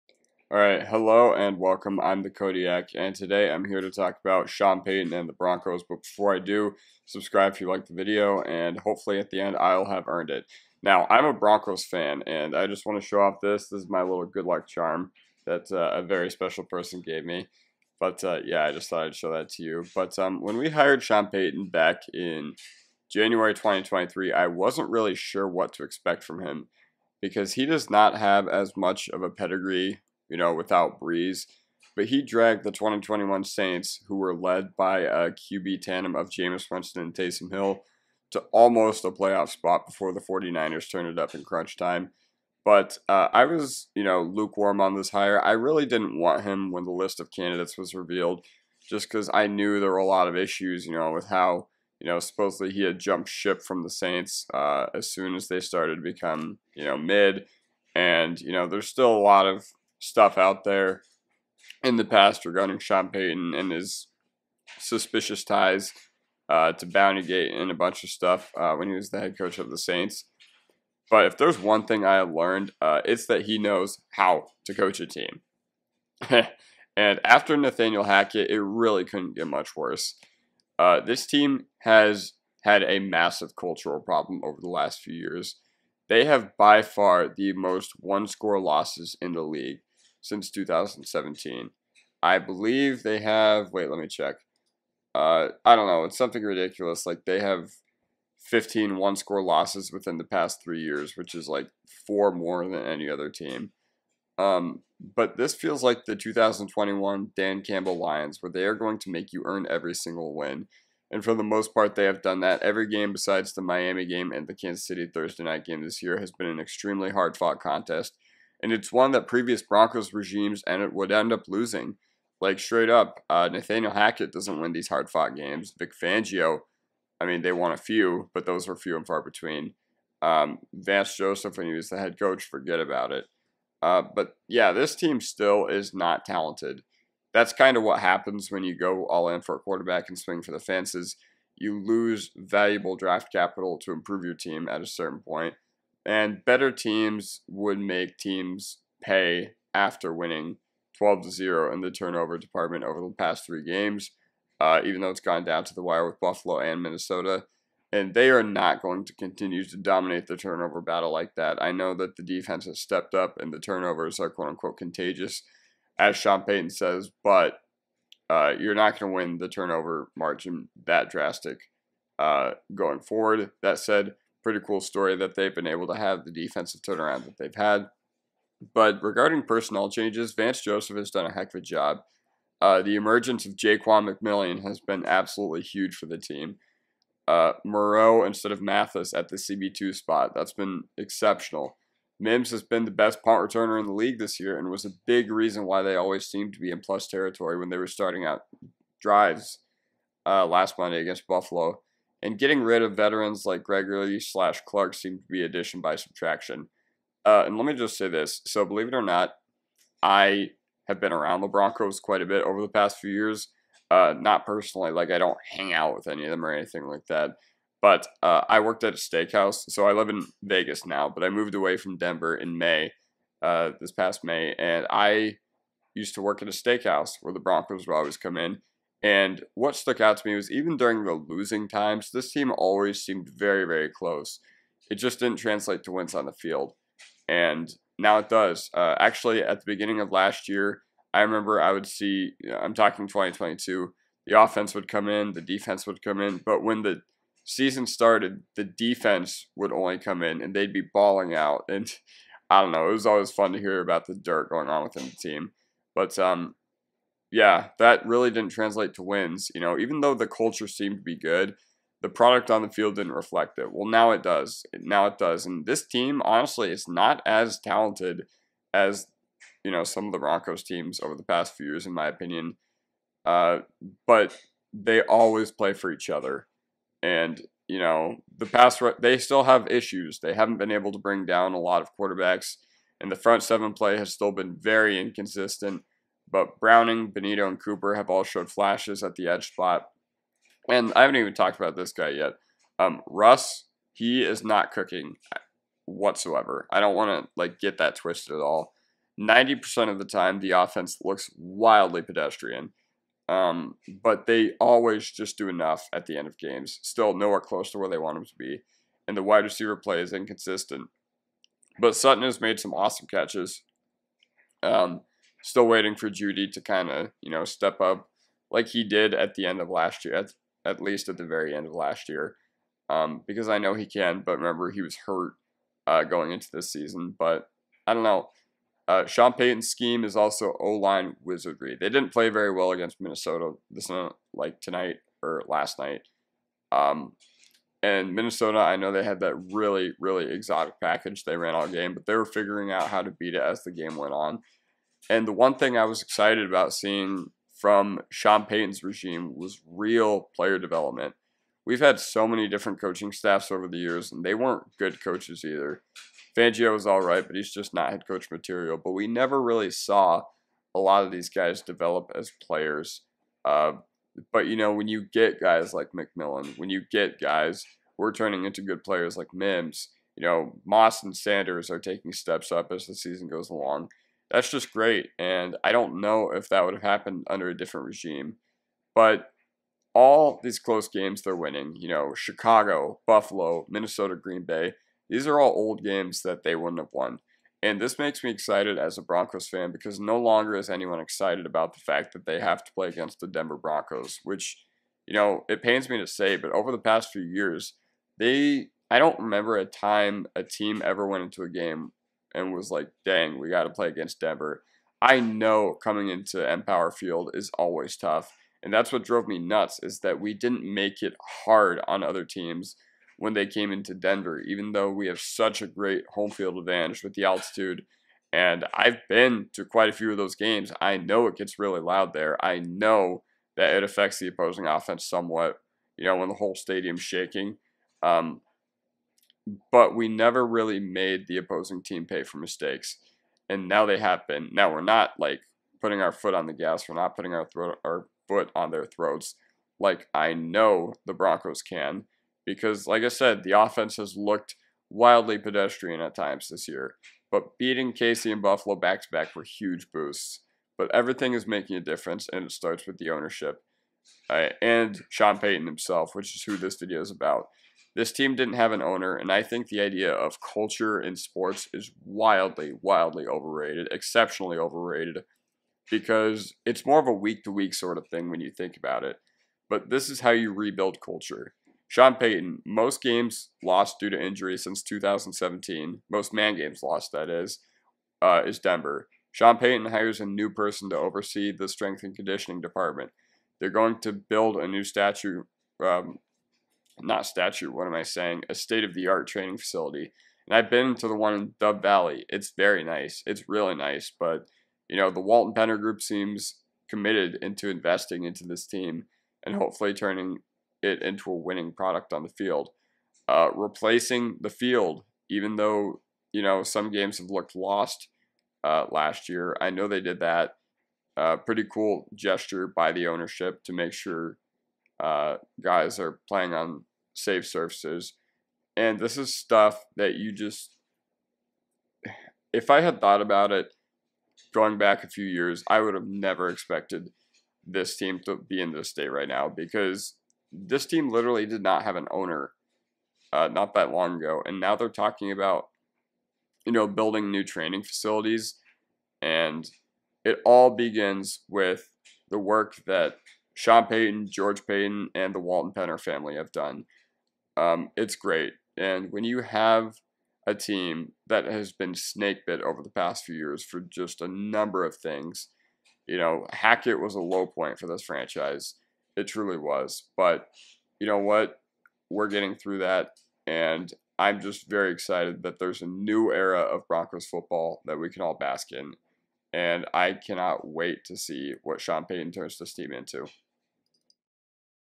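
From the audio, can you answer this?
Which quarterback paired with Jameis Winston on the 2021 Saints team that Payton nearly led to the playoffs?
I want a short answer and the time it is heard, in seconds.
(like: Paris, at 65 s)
Taysom Hill, at 37 s.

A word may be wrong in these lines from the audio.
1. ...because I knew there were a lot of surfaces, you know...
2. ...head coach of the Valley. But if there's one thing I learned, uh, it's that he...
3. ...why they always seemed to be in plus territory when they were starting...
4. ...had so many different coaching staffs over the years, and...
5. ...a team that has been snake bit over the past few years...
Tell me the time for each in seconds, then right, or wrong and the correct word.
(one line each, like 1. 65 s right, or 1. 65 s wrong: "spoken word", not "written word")
1. 49 s wrong: "issues", not "surfaces"
2. 69 s wrong: "Saints", not "Valley"
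3. 195 s right
4. 351 s right
5. 550 s right.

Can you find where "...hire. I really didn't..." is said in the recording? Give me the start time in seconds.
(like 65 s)
45 s.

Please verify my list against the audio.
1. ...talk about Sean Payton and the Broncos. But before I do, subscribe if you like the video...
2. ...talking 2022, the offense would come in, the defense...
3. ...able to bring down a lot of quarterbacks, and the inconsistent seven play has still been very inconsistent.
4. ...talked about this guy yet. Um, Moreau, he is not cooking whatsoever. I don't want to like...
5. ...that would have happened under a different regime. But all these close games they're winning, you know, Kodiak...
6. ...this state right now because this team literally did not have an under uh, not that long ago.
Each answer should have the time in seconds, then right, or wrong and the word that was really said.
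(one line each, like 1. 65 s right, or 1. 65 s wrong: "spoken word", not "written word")
1. 3 s right
2. 242 s right
3. 280 s wrong: "front", not "inconsistent"
4. 291 s wrong: "Russ", not "Moreau"
5. 376 s wrong: "Chicago", not "Kodiak"
6. 528 s wrong: "owner", not "under".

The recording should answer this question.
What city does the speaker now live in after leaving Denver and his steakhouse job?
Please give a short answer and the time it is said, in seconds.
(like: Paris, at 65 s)
Vegas, at 220 s.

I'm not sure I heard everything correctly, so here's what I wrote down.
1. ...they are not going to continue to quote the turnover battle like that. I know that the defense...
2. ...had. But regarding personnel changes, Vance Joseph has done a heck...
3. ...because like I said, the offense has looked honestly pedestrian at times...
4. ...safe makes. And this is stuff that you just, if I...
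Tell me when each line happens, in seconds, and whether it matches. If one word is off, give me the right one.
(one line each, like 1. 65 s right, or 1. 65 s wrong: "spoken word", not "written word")
1. 158 s wrong: "dominate", not "quote"
2. 177 s right
3. 442 s wrong: "wildly", not "honestly"
4. 517 s wrong: "surfaces", not "makes".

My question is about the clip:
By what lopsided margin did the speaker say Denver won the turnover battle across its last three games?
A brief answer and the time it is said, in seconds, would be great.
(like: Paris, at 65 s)
12 to 0, at 150 s.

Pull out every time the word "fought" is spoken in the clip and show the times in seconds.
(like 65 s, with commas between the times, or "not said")
117 s, 125 s.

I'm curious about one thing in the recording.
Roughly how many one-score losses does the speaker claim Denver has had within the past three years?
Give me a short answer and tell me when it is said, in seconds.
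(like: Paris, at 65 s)
15, at 98 s.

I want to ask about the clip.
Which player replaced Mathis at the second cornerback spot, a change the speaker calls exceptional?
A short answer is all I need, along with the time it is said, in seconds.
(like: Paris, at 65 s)
Moreau, at 187 s.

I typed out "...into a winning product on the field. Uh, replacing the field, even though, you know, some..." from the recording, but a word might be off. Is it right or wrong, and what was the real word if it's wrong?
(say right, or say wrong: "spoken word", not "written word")
right.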